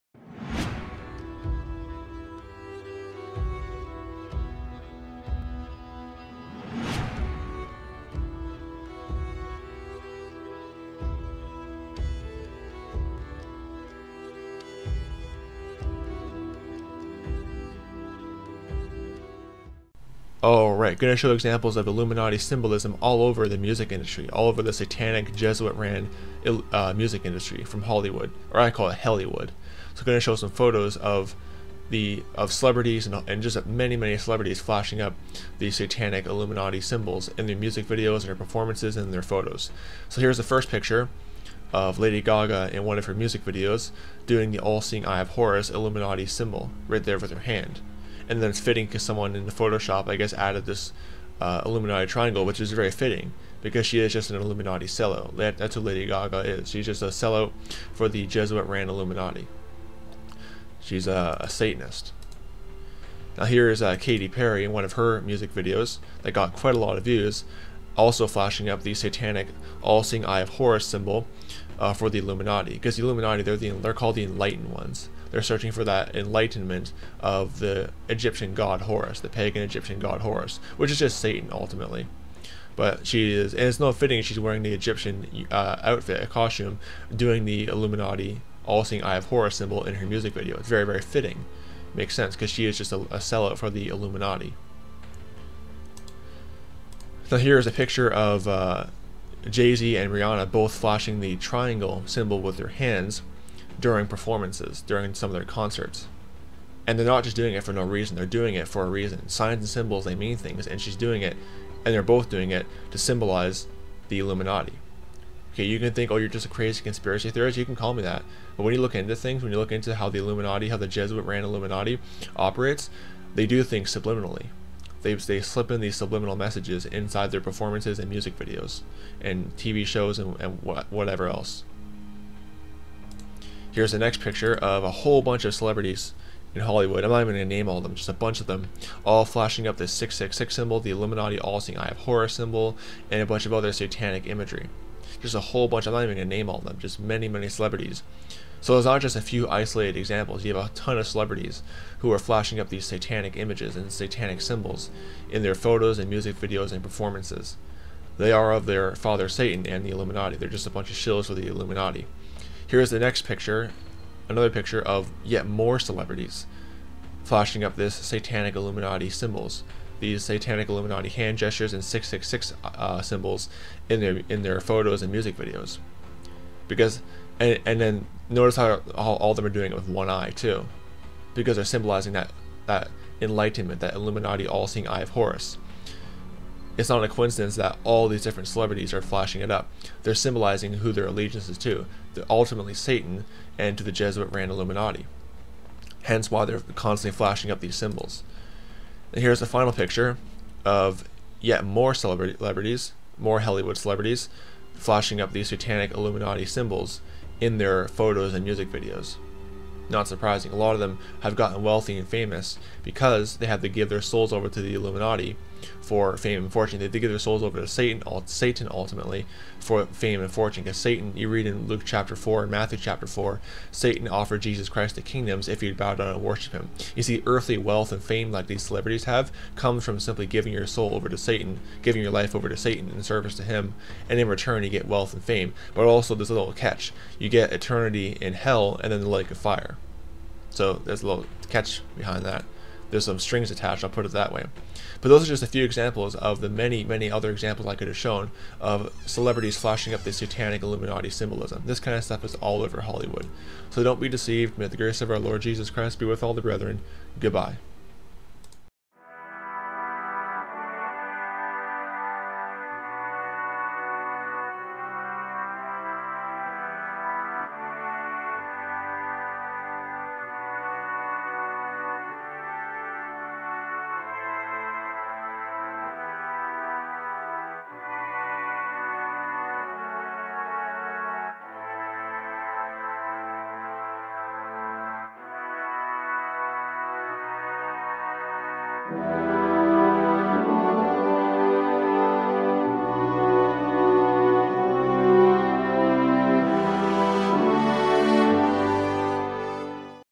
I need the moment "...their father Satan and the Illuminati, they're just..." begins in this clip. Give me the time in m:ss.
2:38.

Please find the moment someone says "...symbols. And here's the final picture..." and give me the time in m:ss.
3:17.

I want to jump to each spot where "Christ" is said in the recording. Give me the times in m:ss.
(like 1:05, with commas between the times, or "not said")
3:44, 4:15.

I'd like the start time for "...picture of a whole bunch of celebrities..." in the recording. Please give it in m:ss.
2:14.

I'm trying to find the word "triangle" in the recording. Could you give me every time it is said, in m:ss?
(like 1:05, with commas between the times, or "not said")
0:52, 1:41.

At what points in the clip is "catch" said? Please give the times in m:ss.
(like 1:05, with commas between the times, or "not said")
3:56, 4:01.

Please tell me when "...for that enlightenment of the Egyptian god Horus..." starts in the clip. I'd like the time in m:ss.
1:15.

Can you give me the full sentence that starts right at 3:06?
It's not a coincidence that all these different celebrities are flashing it up.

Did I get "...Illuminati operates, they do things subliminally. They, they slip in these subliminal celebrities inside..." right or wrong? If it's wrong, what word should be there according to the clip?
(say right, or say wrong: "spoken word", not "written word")
wrong: "messages", not "celebrities".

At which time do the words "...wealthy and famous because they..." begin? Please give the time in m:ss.
3:31.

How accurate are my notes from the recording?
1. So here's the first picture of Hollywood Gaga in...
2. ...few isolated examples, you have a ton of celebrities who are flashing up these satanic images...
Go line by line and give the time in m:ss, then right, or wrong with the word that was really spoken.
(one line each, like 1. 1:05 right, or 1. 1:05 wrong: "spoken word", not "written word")
1. 0:40 wrong: "Lady", not "Hollywood"
2. 2:29 right.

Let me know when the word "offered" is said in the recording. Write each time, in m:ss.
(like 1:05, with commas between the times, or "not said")
3:44.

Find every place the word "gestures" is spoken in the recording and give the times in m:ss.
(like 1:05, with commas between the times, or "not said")
2:51.